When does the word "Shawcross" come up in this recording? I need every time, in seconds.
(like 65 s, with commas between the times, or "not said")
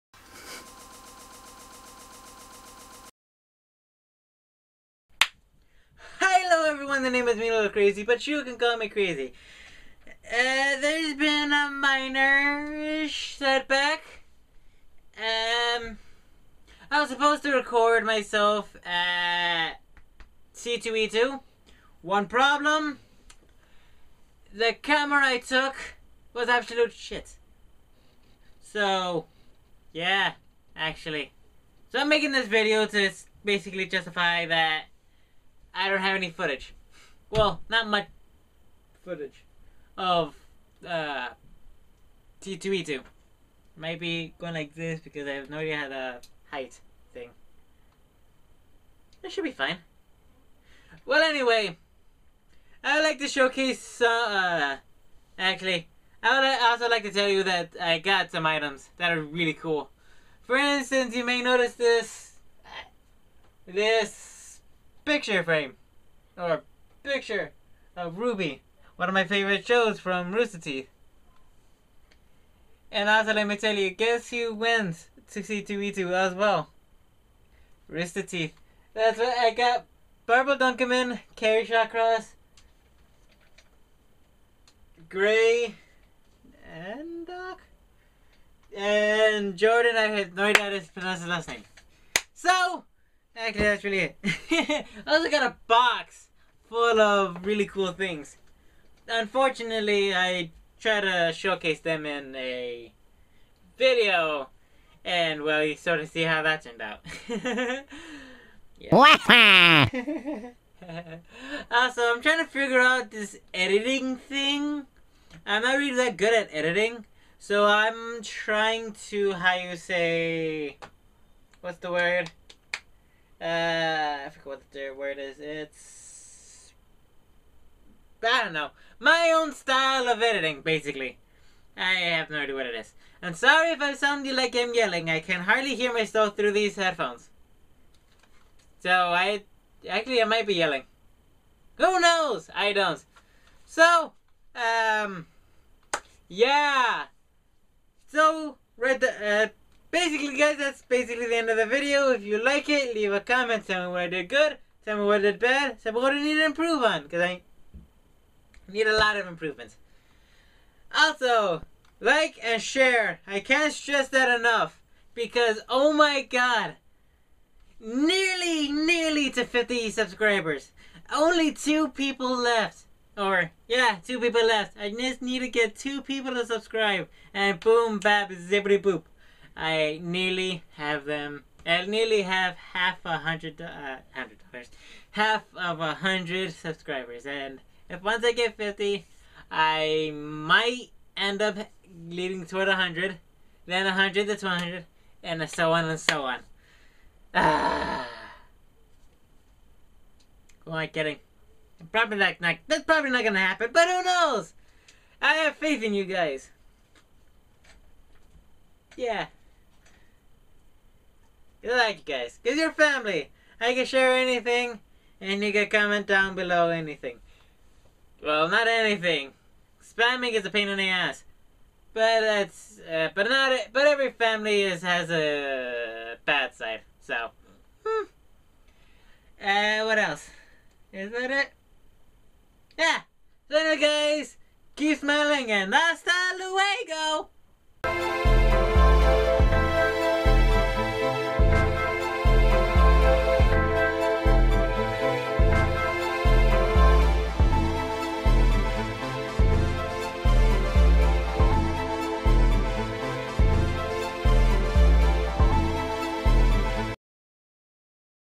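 81 s.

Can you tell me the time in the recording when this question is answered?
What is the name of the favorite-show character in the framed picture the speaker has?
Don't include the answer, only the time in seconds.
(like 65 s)
68 s.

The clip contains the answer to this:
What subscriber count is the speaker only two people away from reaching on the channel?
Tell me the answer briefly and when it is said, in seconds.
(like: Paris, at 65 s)
50, at 169 s.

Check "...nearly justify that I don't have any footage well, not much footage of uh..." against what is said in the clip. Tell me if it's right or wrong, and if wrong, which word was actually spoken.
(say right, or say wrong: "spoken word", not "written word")
wrong: "basically", not "nearly".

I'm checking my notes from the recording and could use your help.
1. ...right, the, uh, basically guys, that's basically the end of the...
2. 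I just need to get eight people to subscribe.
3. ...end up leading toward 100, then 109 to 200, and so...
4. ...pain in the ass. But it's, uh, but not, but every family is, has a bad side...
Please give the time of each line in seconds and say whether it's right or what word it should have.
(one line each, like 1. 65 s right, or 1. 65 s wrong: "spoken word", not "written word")
1. 148 s right
2. 174 s wrong: "two", not "eight"
3. 191 s wrong: "100", not "109"
4. 220 s right.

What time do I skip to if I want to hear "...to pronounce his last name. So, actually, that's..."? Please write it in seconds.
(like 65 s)
90 s.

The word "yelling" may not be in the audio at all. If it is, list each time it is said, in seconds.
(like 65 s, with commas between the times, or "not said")
134 s, 140 s.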